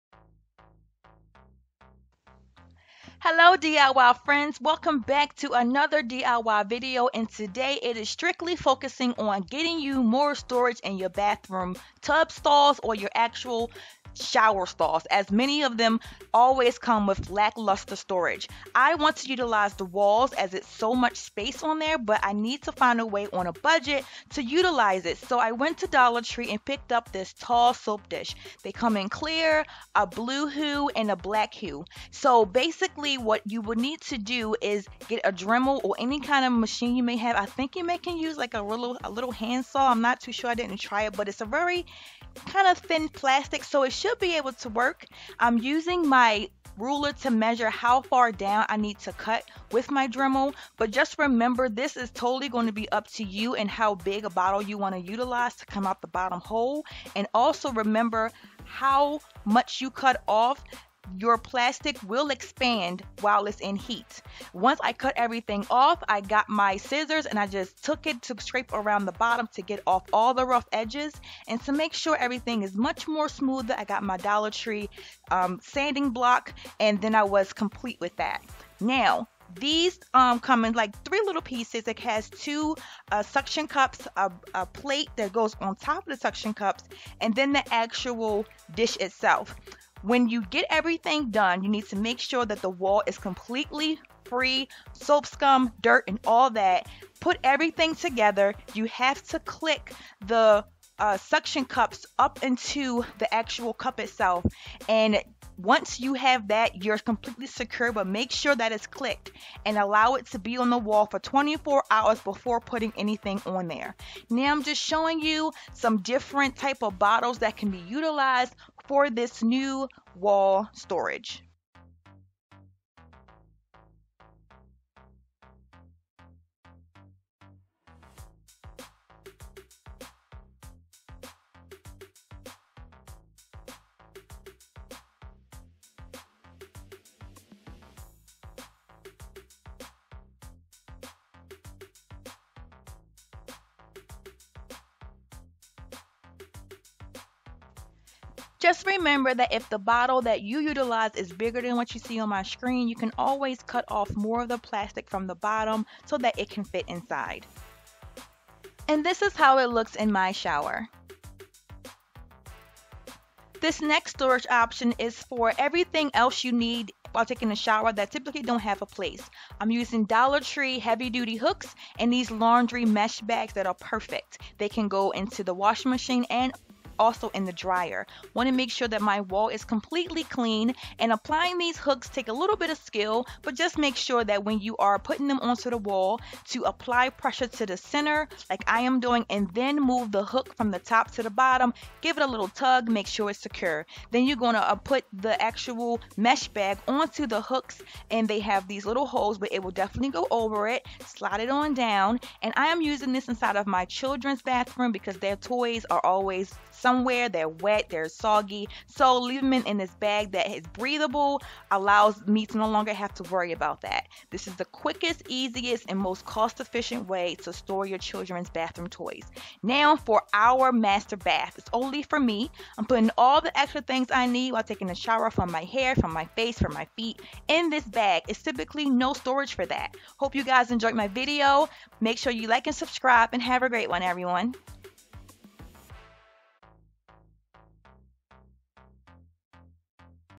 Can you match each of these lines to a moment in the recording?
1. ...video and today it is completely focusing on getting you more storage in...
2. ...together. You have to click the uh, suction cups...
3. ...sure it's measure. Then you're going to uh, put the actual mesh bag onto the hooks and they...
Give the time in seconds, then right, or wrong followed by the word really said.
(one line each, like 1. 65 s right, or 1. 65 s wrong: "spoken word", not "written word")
1. 6 s wrong: "strictly", not "completely"
2. 97 s right
3. 193 s wrong: "secure", not "measure".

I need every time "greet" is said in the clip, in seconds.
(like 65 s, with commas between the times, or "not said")
not said.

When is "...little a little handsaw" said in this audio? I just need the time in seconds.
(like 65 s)
38 s.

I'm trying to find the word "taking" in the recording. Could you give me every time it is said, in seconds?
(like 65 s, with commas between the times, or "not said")
167 s, 224 s.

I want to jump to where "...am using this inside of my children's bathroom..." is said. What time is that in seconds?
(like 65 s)
202 s.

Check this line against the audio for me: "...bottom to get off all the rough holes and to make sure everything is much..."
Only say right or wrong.
wrong.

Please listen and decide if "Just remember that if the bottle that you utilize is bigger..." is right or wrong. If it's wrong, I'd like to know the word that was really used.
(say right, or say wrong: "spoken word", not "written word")
right.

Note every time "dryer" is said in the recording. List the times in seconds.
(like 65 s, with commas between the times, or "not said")
177 s.